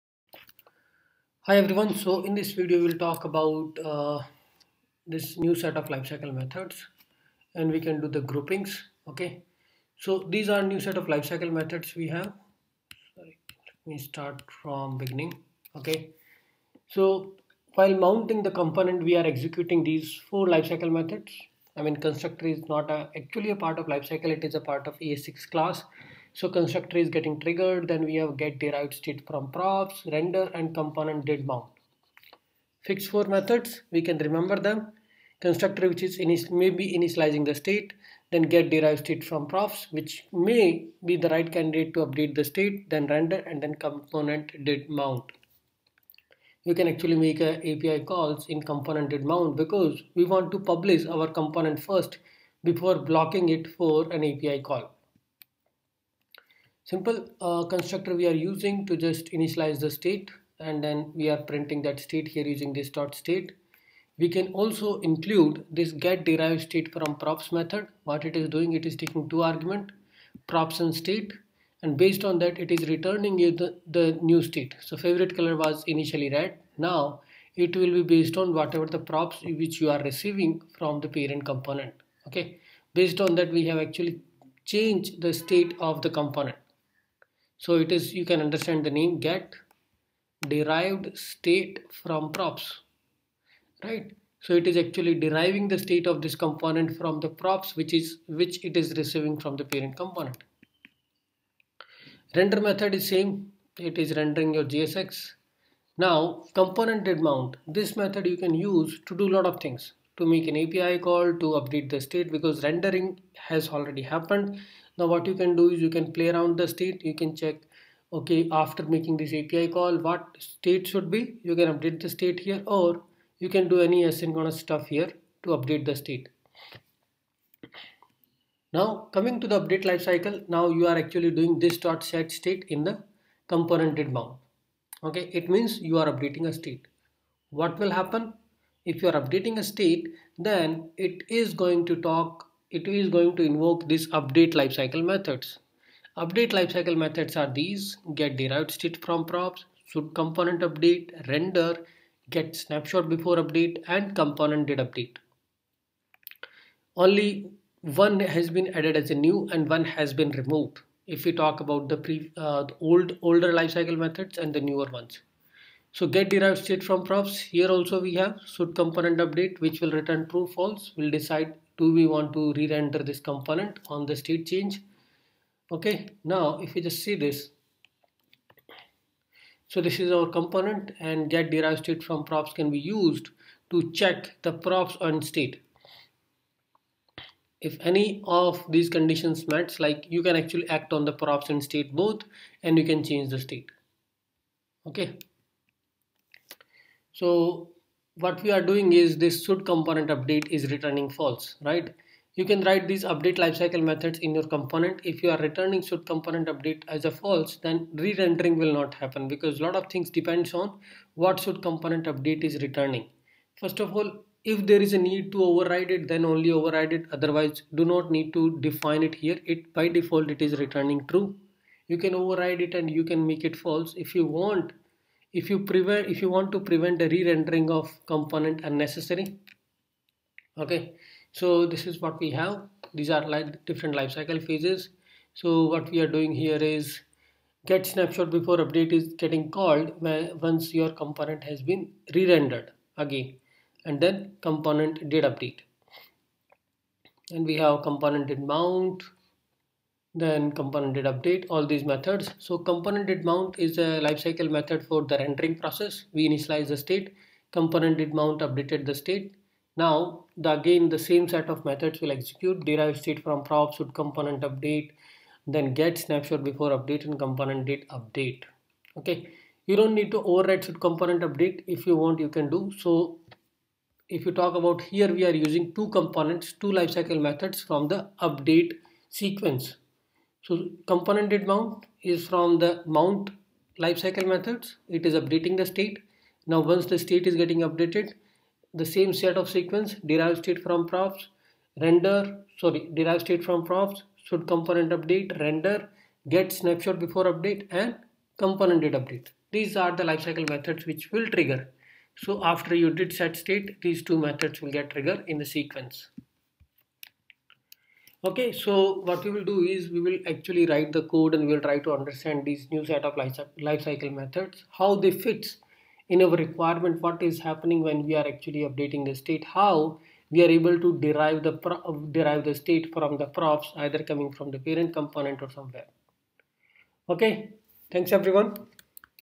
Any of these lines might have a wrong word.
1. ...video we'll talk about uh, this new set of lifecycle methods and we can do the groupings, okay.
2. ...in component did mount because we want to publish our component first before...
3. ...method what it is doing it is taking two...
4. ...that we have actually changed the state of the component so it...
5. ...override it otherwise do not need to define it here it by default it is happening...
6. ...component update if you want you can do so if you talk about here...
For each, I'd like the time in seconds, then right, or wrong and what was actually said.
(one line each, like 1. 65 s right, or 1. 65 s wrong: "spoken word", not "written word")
1. 2 s right
2. 48 s right
3. 67 s right
4. 83 s right
5. 216 s wrong: "returning", not "happening"
6. 270 s right.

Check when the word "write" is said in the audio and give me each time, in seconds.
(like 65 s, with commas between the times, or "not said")
202 s, 310 s.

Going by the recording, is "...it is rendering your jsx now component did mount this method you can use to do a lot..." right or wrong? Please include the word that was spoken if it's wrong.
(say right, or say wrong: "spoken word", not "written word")
right.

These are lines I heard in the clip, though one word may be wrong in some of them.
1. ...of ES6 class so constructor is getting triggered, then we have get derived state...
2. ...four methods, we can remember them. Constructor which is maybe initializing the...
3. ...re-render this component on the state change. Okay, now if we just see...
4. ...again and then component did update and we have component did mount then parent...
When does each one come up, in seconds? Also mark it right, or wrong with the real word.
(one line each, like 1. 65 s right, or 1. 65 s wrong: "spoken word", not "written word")
1. 24 s right
2. 33 s right
3. 172 s right
4. 242 s wrong: "component", not "parent".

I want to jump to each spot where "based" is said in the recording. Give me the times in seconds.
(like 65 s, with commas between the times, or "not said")
71 s, 78 s, 82 s.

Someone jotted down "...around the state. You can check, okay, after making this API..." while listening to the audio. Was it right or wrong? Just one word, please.
right.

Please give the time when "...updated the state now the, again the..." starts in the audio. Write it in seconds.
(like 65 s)
258 s.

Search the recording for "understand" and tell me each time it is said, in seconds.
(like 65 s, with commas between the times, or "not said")
88 s, 311 s.